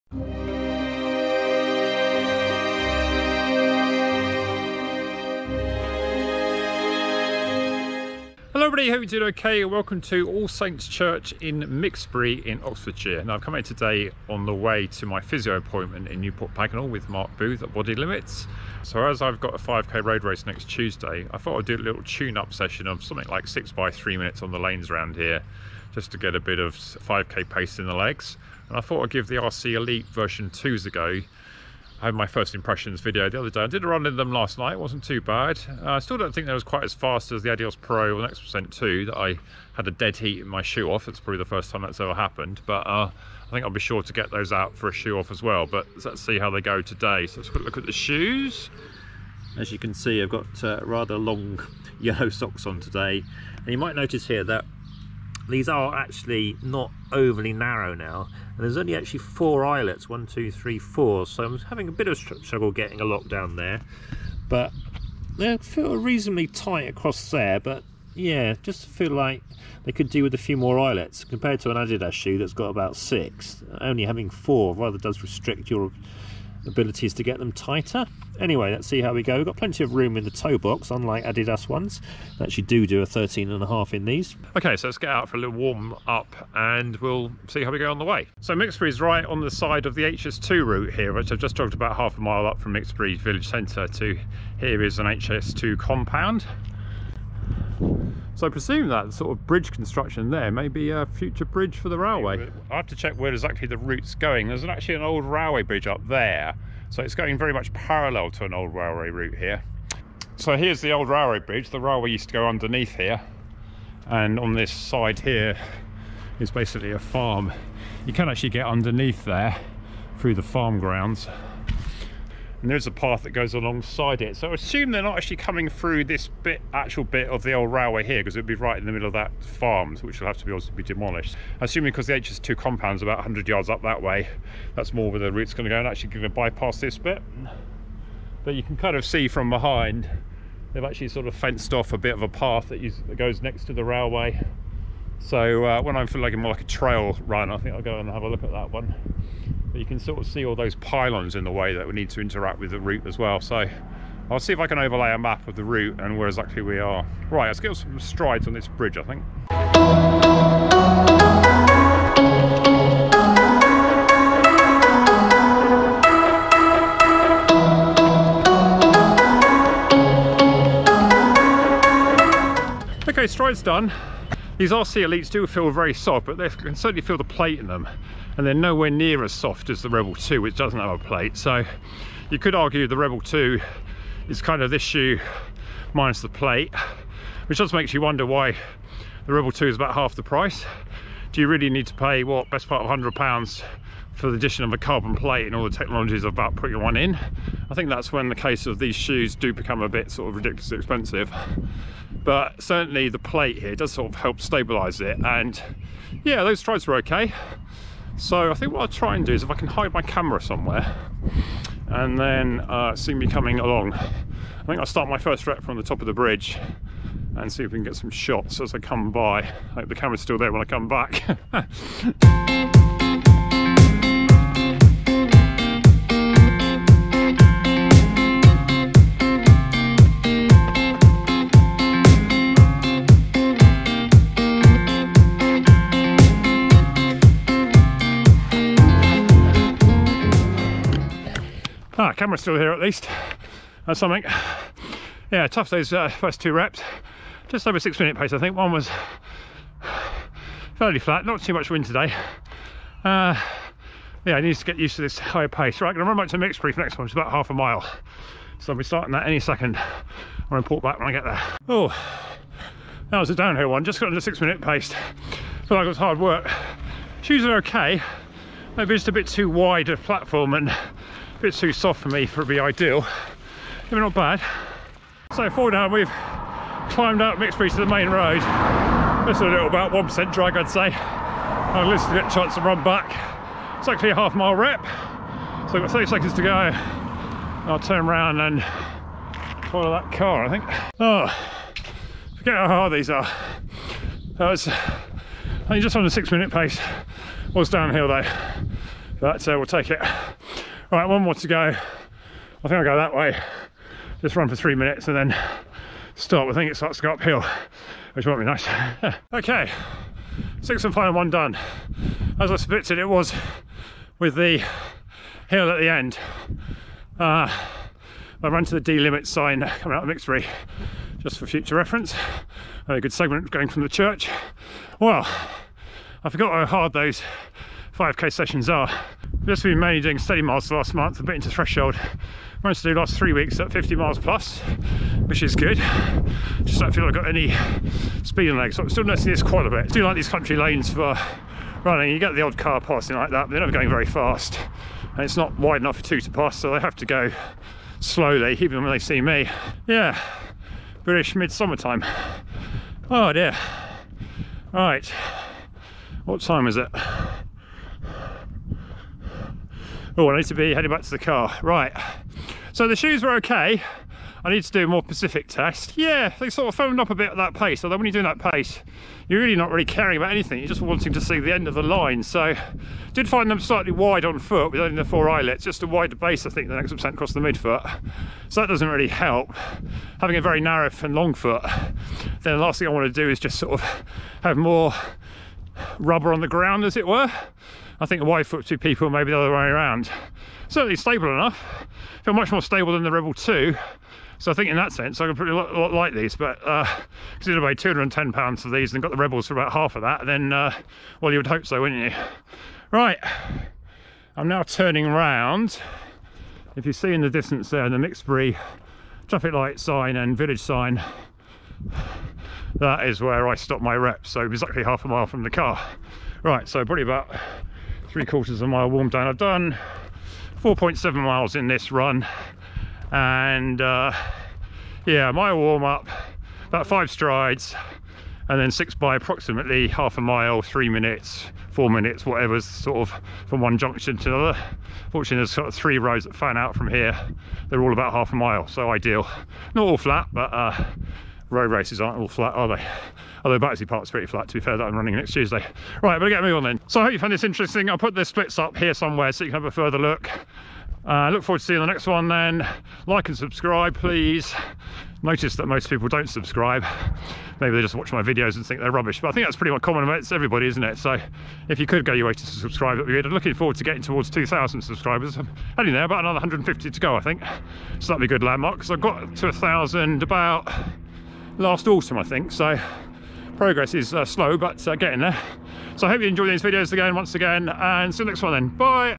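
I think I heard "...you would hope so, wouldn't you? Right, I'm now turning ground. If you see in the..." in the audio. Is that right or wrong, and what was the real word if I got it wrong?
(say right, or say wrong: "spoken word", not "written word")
wrong: "round", not "ground".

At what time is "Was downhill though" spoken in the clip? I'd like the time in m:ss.
4:57.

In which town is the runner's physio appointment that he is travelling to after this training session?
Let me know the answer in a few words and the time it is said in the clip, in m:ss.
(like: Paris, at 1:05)
Newport Pagnell, at 0:16.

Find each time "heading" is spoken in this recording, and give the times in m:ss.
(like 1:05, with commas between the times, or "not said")
6:00, 7:45.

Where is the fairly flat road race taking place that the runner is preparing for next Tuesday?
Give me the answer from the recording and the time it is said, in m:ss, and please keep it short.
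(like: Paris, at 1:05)
Battersea Park, at 7:23.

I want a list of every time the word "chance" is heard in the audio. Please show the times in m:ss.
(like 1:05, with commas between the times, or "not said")
4:42.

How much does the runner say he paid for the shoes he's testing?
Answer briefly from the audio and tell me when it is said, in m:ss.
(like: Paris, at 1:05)
210 pounds, at 6:37.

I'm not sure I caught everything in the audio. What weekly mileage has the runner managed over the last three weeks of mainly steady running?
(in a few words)
50 miles plus.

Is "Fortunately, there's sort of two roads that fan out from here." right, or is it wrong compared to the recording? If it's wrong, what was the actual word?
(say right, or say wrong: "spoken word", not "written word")
wrong: "three", not "two".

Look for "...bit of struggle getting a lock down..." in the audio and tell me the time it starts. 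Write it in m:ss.
1:01.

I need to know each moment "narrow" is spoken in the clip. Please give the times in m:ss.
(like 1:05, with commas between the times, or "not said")
0:57, 6:20.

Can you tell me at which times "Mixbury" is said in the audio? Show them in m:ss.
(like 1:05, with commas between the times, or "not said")
0:11, 1:28, 1:32, 4:16, 5:20, 6:47.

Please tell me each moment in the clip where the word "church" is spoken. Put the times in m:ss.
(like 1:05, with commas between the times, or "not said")
0:10, 5:23.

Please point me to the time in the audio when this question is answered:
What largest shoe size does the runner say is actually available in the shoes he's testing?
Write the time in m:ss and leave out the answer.
1:23.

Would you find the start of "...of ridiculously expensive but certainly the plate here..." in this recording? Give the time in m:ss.
3:20.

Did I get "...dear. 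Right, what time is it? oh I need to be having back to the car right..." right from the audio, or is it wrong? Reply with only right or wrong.
wrong.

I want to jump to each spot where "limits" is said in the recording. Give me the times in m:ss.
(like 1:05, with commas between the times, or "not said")
0:17, 5:18.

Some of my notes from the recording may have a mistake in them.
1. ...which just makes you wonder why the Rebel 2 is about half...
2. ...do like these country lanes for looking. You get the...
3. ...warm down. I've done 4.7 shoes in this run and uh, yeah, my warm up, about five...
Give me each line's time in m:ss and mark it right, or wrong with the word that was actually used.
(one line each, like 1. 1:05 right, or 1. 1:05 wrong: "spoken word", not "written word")
1. 3:07 right
2. 5:39 wrong: "running", not "looking"
3. 6:58 wrong: "miles", not "shoes".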